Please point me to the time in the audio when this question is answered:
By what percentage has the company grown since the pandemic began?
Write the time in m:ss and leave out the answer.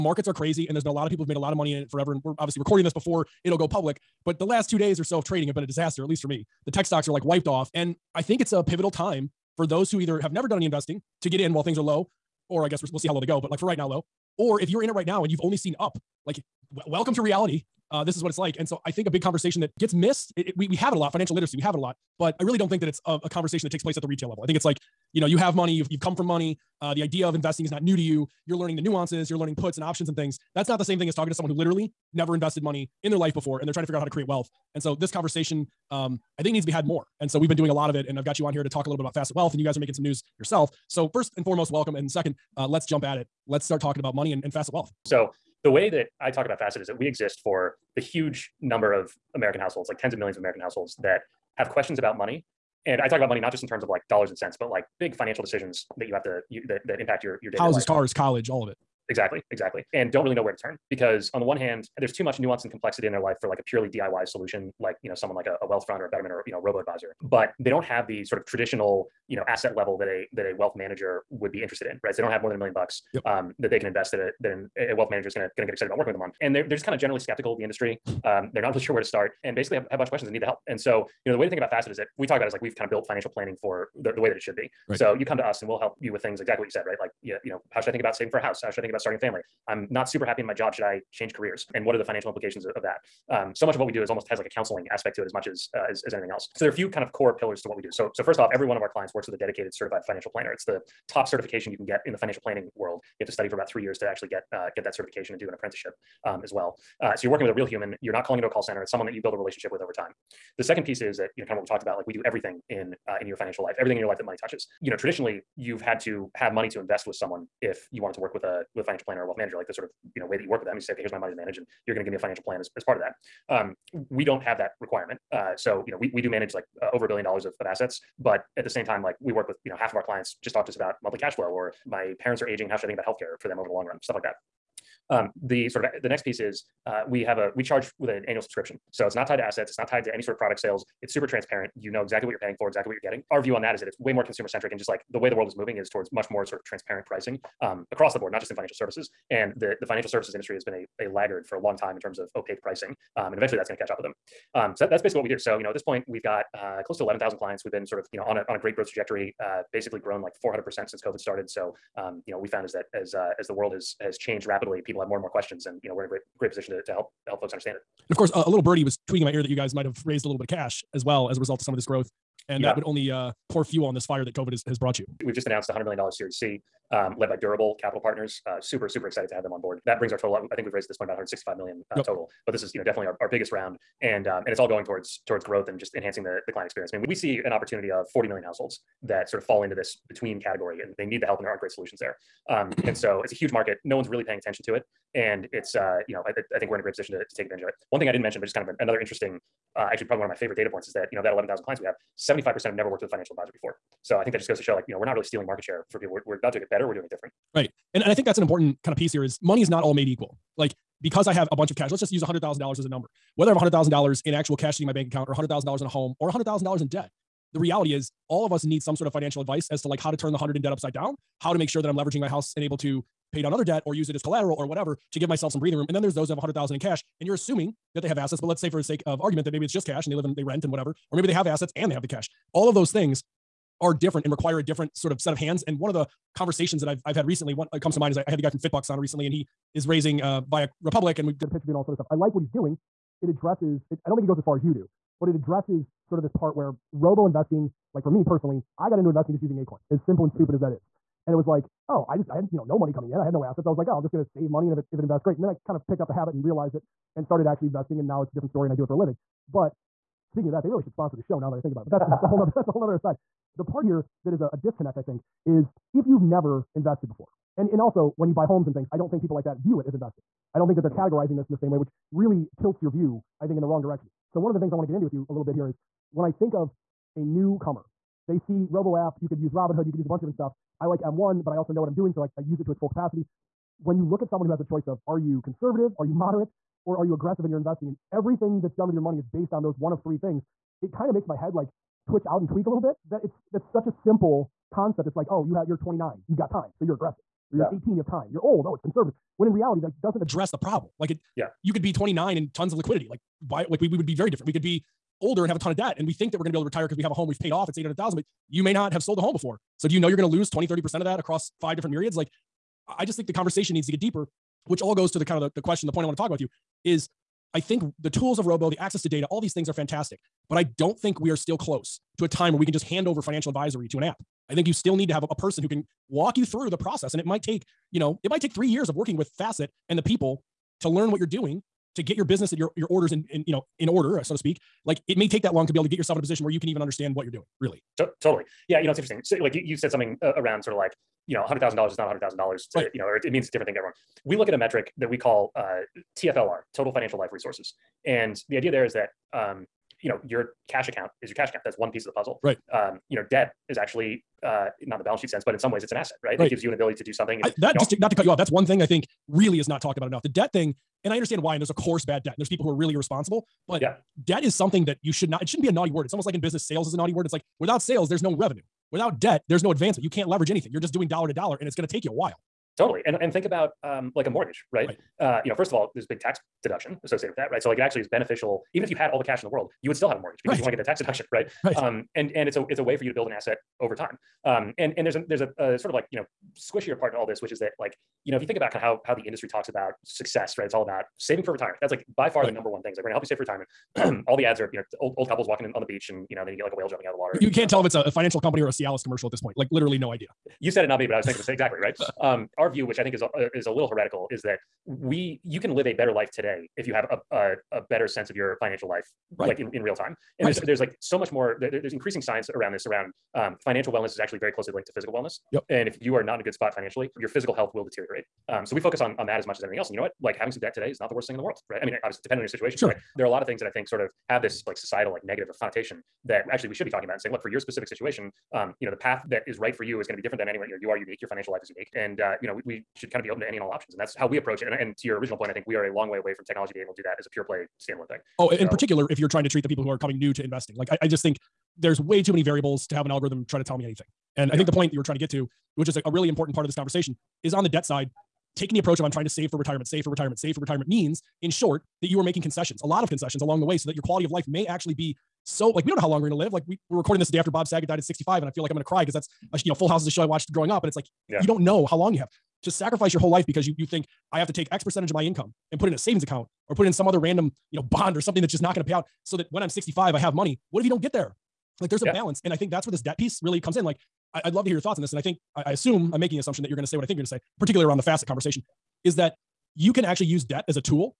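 2:40.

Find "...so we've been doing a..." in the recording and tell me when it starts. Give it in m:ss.
0:37.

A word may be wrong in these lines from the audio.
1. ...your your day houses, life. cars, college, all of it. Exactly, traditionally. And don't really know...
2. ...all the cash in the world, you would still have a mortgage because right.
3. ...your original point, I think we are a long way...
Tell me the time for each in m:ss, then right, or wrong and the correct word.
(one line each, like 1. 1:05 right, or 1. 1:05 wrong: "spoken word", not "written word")
1. 0:57 wrong: "exactly", not "traditionally"
2. 6:19 right
3. 7:15 right.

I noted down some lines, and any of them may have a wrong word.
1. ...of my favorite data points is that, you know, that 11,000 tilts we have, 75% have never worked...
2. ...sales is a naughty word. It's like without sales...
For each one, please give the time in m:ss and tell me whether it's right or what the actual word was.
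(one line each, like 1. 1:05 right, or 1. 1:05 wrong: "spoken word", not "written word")
1. 3:20 wrong: "clients", not "tilts"
2. 6:06 right.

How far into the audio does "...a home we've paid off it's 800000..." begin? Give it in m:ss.
5:07.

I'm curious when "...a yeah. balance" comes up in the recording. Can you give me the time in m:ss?
7:52.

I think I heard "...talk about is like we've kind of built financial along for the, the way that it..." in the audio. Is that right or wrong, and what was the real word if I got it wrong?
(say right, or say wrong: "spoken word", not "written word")
wrong: "planning", not "along".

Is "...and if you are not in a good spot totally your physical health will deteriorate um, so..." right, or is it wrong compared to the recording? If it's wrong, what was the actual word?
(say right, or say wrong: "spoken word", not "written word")
wrong: "financially", not "totally".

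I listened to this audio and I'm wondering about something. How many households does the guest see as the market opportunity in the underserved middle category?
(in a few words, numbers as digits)
40 million.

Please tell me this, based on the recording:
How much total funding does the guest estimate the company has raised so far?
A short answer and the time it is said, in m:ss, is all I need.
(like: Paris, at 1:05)
165 million, at 3:01.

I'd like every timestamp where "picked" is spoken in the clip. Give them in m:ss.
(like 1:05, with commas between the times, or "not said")
4:15.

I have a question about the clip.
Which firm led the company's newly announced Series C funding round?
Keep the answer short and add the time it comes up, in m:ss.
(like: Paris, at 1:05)
Durable Capital Partners, at 2:57.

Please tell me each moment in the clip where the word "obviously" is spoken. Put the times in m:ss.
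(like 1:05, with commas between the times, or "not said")
0:02, 7:02.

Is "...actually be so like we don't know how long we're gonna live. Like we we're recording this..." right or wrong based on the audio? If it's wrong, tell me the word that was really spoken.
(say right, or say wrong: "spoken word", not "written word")
right.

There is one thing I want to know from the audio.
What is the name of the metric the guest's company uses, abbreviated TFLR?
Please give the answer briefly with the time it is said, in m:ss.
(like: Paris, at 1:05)
Total Financial Life Resources, at 5:46.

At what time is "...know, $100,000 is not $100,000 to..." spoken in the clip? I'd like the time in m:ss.
5:41.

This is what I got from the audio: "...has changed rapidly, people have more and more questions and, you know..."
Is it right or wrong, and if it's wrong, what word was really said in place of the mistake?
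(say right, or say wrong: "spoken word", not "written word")
right.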